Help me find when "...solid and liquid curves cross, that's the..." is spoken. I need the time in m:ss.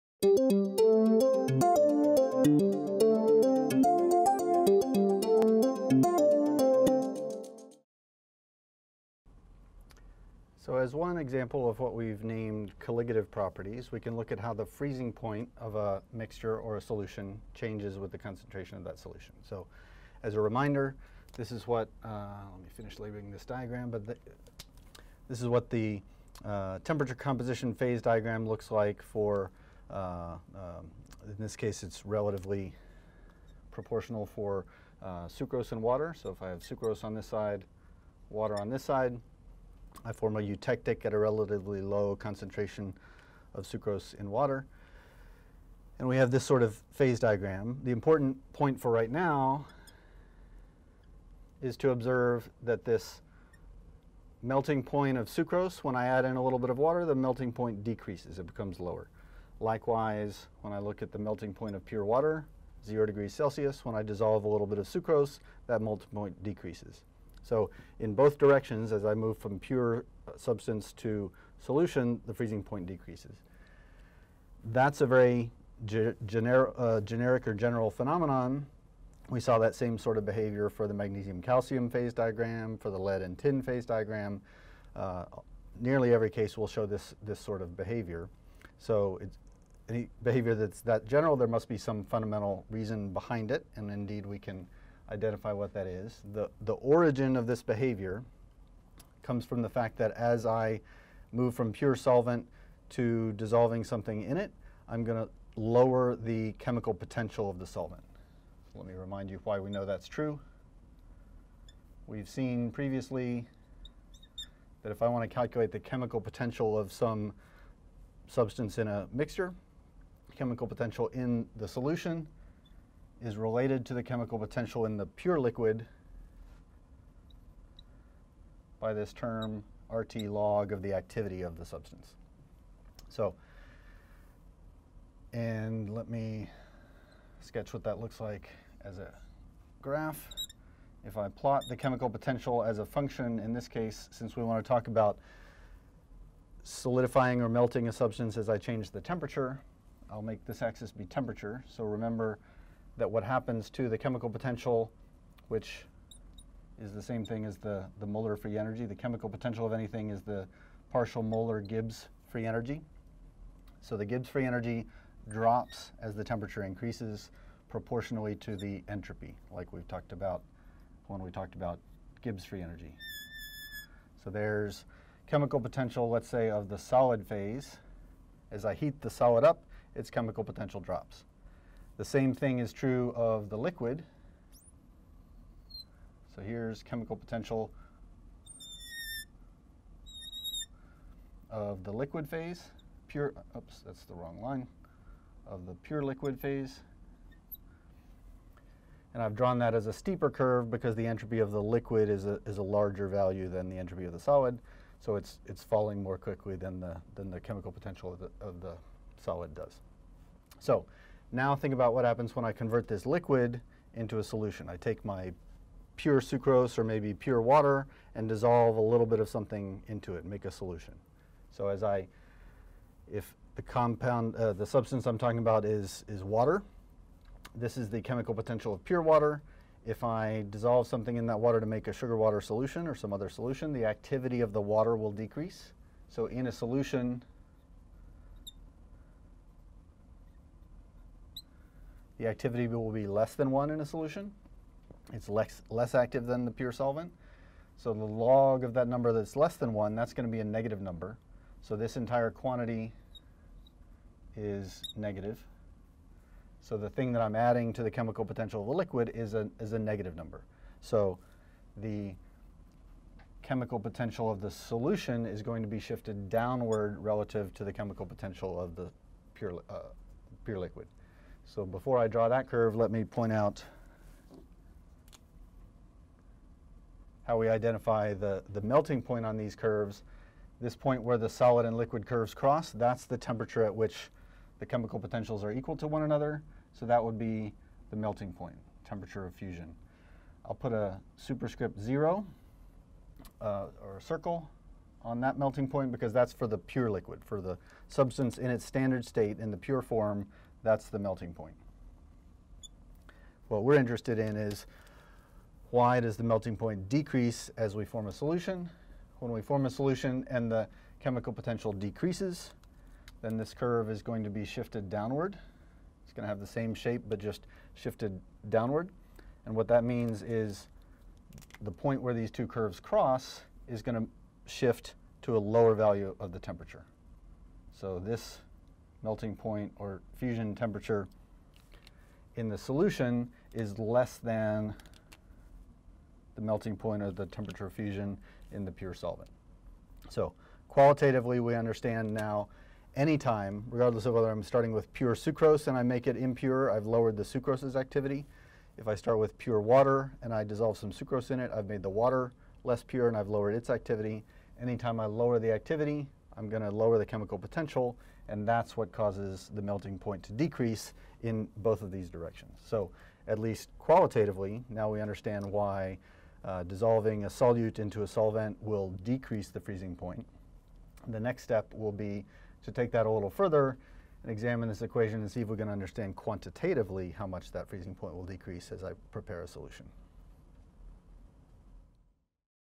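4:41.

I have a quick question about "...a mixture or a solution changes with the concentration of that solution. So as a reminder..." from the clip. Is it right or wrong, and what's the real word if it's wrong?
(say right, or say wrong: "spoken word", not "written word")
right.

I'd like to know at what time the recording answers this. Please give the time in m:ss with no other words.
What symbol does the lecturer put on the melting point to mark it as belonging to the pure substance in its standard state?
4:51.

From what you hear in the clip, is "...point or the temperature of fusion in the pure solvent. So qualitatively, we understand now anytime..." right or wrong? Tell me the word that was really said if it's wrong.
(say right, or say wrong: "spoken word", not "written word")
right.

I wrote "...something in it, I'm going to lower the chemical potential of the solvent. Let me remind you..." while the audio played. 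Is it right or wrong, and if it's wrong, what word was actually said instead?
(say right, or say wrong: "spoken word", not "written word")
right.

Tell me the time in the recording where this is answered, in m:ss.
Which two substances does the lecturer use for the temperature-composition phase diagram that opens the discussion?
0:35.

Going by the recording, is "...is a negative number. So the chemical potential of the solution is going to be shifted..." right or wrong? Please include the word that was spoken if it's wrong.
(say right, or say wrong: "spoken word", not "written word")
right.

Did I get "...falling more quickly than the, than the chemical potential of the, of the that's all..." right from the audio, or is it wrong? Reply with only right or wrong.
right.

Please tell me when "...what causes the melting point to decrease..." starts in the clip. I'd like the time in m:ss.
5:58.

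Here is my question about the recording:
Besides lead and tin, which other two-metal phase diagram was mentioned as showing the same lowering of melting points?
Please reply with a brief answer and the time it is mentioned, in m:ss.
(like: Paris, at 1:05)
Magnesium-calcium, at 1:20.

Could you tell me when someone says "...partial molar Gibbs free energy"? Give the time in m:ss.
2:40.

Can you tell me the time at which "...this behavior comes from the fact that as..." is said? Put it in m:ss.
1:37.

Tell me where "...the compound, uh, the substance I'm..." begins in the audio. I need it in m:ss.
3:43.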